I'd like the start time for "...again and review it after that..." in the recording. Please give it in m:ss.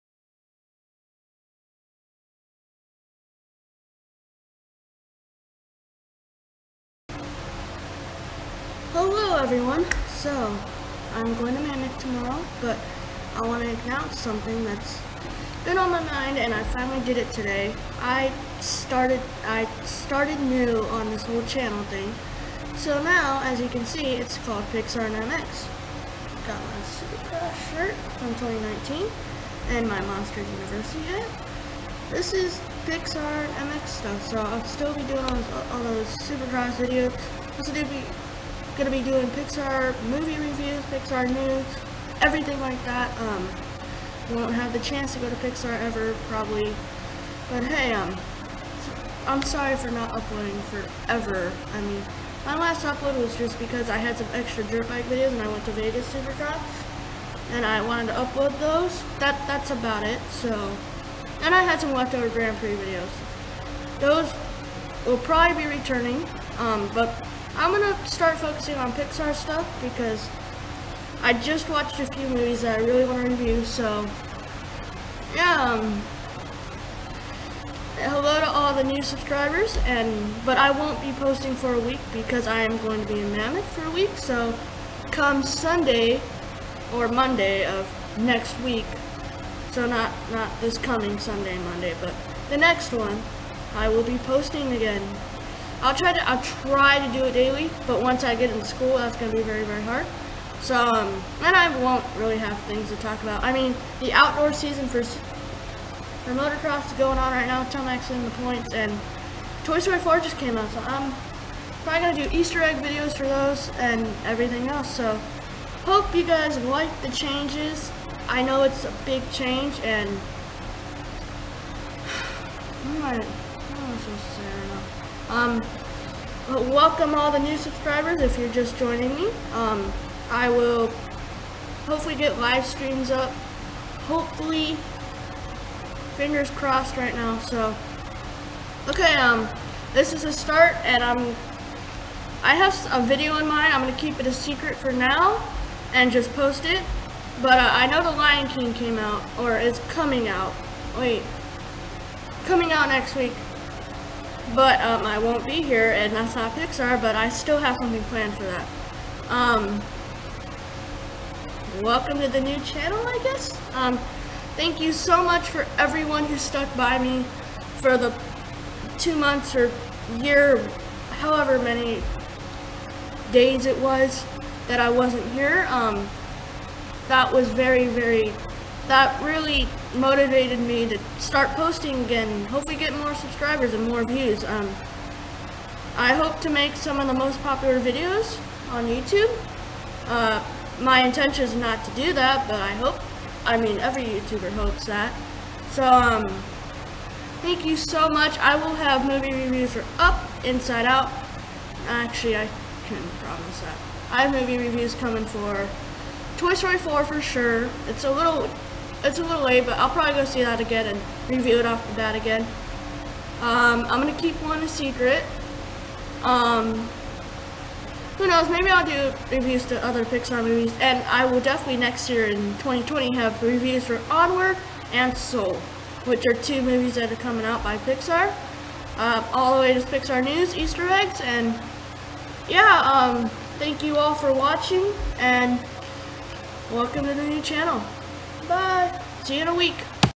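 3:30.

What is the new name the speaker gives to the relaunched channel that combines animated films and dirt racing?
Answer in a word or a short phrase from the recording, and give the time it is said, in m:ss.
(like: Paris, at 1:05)
Pixar and MX, at 0:24.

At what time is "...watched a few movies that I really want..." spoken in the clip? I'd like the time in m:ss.
1:11.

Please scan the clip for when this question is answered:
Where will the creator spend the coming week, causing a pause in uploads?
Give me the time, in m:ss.
1:23.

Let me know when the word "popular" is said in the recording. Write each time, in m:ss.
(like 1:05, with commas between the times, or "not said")
3:07.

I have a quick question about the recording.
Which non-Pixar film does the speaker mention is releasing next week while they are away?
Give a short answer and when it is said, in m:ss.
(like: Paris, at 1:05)
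The Lion King, at 2:28.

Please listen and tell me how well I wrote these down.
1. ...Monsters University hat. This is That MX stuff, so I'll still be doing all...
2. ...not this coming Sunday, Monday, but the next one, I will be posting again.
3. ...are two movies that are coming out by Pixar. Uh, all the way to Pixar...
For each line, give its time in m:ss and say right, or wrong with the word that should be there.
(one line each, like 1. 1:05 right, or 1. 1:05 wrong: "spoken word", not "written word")
1. 0:30 wrong: "Pixar", not "That"
2. 1:30 right
3. 3:46 right.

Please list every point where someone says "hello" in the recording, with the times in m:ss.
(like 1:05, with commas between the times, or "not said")
0:08, 1:17.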